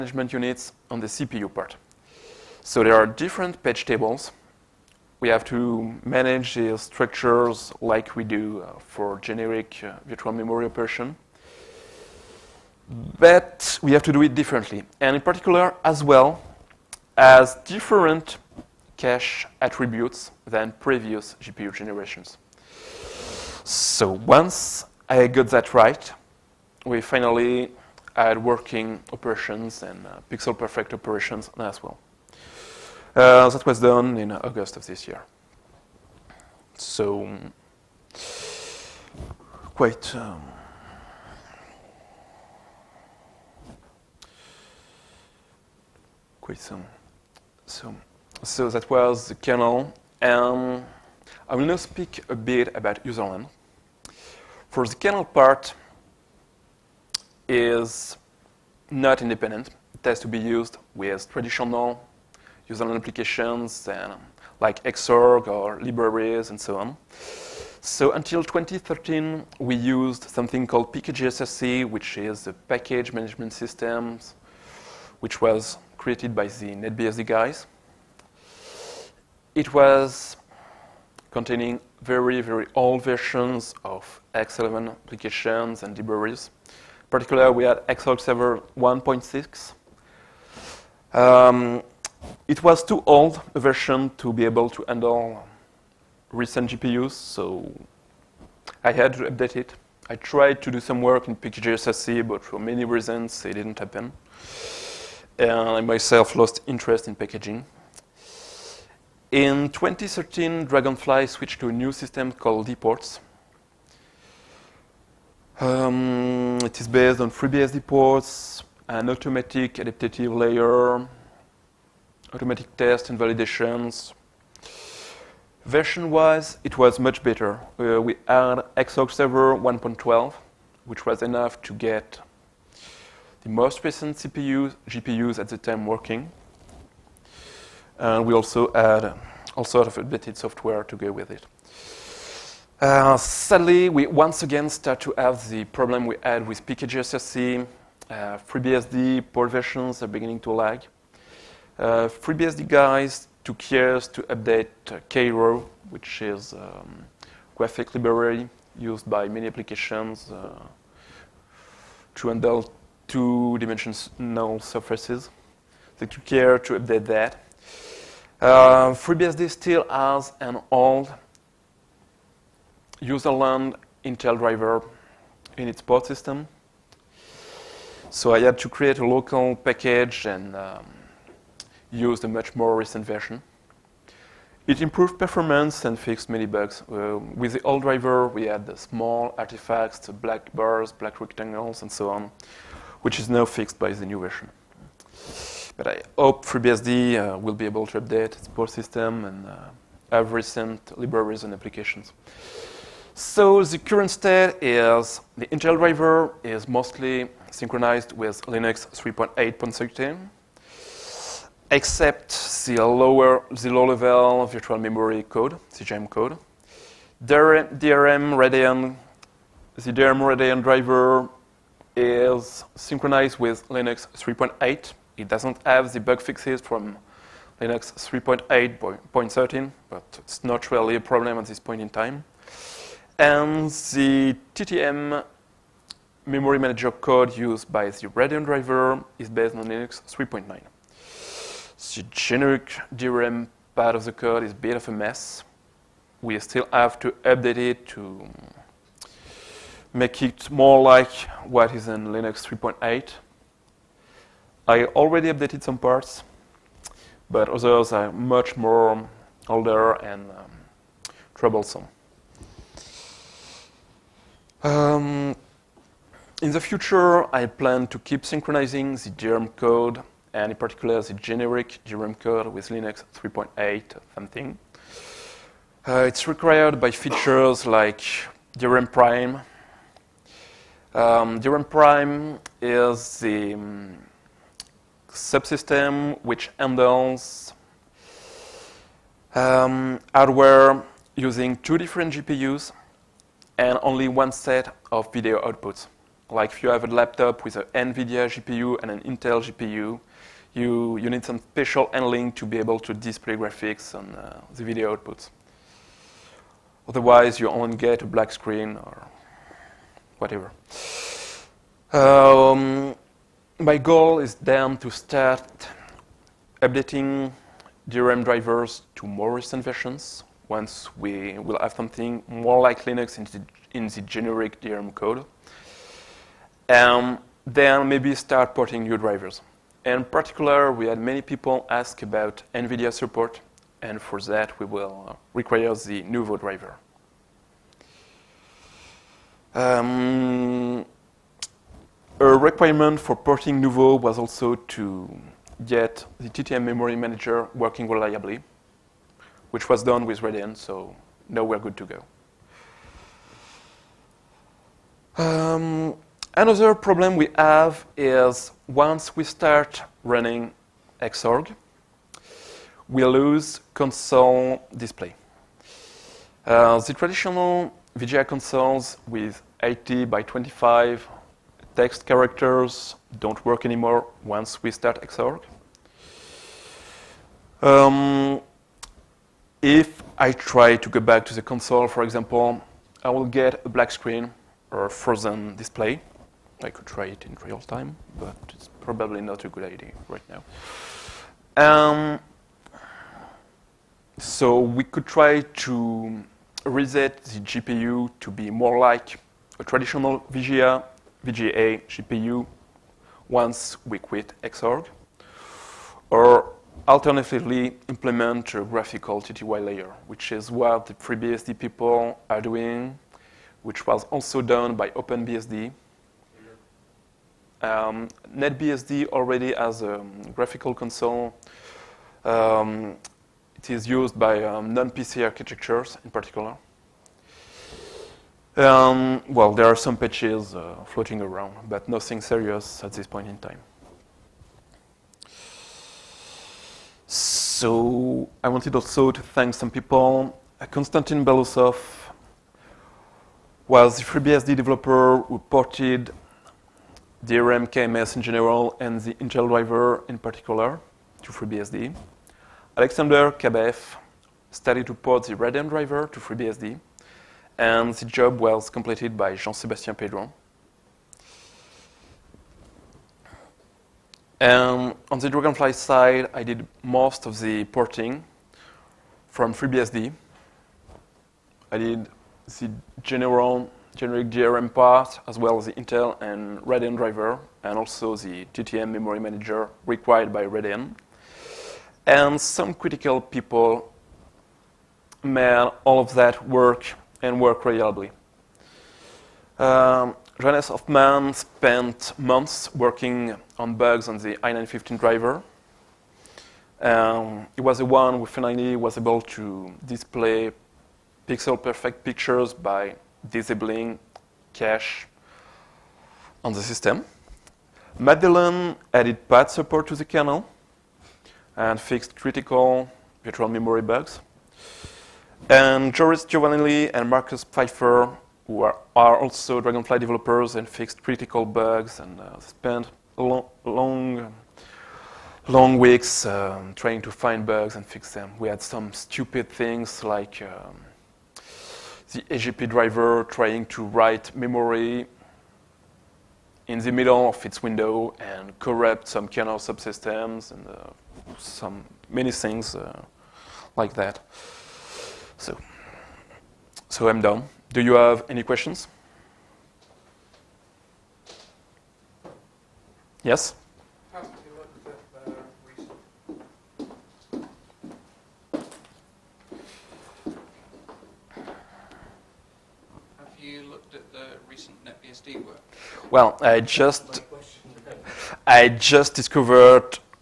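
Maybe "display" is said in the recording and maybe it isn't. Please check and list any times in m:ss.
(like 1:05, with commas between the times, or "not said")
5:02, 6:04, 6:25, 8:19.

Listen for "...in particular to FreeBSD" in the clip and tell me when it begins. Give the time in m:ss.
7:30.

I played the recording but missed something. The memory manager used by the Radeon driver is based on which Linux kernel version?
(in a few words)
Linux 3.9.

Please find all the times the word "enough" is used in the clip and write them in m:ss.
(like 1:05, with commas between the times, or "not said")
2:11.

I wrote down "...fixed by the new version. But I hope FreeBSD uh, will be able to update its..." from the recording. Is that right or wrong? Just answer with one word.
right.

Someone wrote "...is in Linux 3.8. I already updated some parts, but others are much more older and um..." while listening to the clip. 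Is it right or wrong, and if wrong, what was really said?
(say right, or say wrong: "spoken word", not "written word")
right.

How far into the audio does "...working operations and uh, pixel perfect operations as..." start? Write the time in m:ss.
0:28.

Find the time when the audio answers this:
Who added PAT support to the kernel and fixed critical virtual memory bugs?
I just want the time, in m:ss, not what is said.
8:27.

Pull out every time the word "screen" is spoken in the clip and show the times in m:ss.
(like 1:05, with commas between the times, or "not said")
5:08, 6:23.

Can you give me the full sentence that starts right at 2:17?
And we also add all sort of updated software to go with it.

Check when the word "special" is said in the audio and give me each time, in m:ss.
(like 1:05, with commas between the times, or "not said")
5:01.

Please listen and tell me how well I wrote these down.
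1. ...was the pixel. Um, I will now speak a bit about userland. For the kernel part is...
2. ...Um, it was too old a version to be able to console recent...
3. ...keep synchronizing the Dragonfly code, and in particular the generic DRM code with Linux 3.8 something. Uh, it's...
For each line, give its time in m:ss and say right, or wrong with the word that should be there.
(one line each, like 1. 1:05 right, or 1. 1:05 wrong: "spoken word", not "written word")
1. 0:48 wrong: "kernel", not "pixel"
2. 1:31 wrong: "handle", not "console"
3. 4:27 wrong: "DRM", not "Dragonfly".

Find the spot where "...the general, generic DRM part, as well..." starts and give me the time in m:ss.
7:52.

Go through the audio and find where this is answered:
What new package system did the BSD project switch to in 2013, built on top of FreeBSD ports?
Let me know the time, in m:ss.
1:52.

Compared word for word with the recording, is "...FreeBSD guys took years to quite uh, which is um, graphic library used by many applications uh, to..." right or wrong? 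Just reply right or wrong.
wrong.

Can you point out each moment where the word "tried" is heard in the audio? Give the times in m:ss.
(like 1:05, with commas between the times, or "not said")
1:40.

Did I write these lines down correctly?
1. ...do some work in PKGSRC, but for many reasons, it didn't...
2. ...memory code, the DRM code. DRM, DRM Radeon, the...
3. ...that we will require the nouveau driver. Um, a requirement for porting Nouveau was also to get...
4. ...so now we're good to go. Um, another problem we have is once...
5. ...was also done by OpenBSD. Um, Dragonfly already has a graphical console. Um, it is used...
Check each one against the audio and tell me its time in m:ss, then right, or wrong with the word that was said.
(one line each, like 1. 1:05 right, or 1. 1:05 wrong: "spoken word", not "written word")
1. 1:40 right
2. 3:34 right
3. 5:34 right
4. 5:50 right
5. 6:53 wrong: "NetBSD", not "Dragonfly".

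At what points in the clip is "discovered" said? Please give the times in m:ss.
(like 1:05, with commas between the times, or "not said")
9:29.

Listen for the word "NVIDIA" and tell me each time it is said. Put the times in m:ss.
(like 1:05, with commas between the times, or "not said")
4:57, 5:32.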